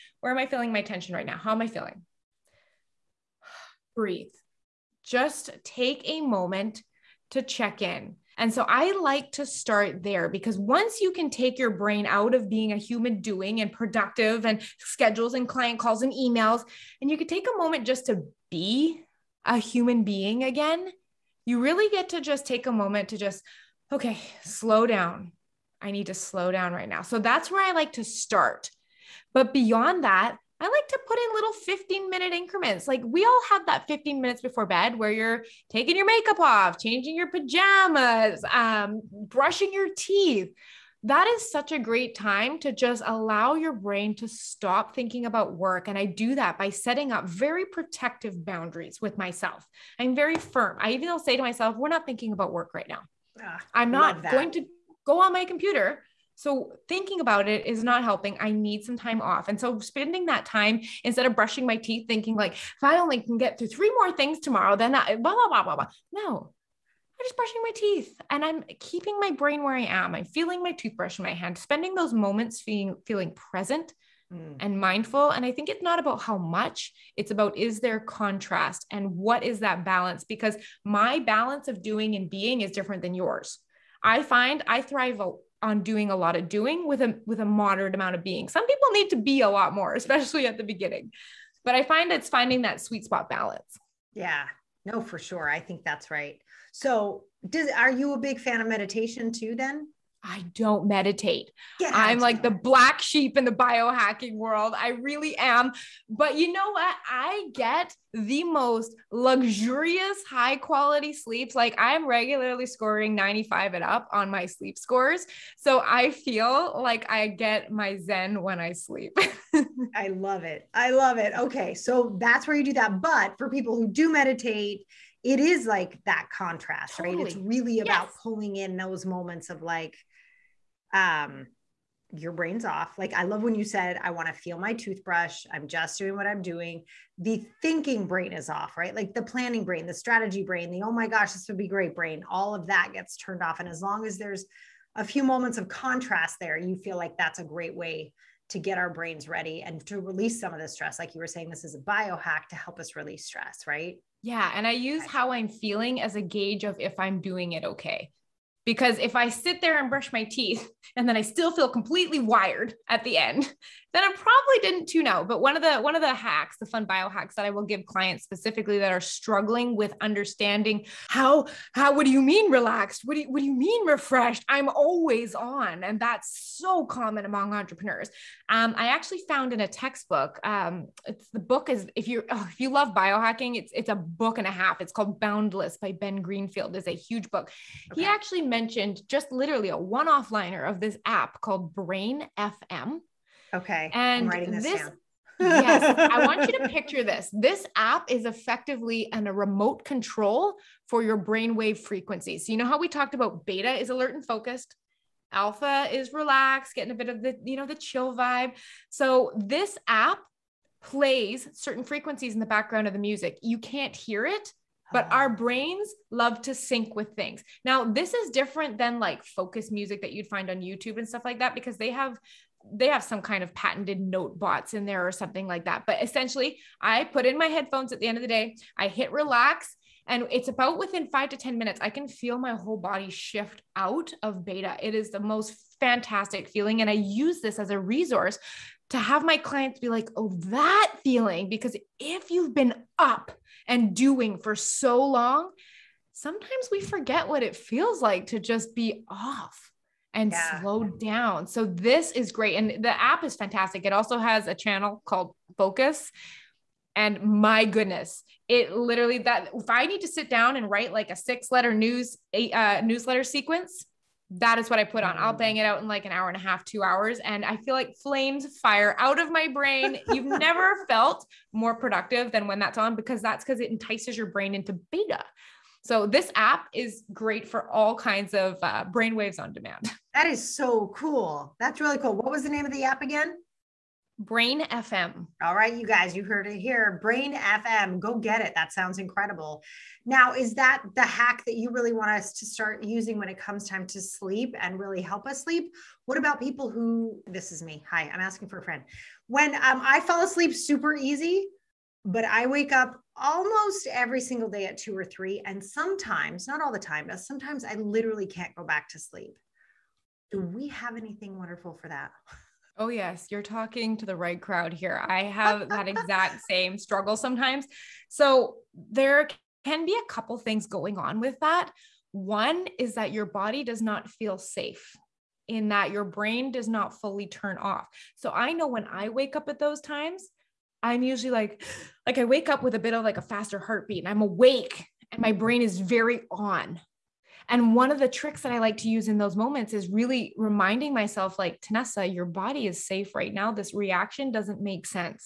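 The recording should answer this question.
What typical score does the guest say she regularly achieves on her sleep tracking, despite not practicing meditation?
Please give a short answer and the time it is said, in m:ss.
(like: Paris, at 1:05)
95, at 1:53.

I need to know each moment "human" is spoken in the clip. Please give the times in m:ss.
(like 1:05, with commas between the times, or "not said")
0:12, 0:19.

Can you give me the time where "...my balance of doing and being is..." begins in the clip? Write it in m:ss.
1:20.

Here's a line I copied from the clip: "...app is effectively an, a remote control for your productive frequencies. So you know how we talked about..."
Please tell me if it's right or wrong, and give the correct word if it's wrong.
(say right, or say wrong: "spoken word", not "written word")
wrong: "brainwave", not "productive".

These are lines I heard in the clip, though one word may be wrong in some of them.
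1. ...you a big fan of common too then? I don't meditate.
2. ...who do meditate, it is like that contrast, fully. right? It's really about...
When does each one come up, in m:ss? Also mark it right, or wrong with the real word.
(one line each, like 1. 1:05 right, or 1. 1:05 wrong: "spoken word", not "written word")
1. 1:37 wrong: "meditation", not "common"
2. 2:03 wrong: "totally", not "fully".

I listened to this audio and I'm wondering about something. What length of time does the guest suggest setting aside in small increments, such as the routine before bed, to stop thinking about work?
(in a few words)
15 minutes.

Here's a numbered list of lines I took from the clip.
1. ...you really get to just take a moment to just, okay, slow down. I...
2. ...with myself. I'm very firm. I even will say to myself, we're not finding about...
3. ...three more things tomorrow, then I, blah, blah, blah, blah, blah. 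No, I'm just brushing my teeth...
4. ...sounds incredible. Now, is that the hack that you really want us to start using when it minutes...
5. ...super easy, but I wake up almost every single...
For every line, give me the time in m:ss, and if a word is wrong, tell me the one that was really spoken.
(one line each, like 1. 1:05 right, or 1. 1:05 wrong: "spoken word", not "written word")
1. 0:21 right
2. 0:48 wrong: "thinking", not "finding"
3. 1:03 right
4. 4:48 wrong: "comes", not "minutes"
5. 5:00 right.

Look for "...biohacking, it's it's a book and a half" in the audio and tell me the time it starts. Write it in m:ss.
3:02.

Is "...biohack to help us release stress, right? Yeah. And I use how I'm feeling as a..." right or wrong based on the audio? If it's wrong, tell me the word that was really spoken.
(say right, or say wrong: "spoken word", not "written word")
right.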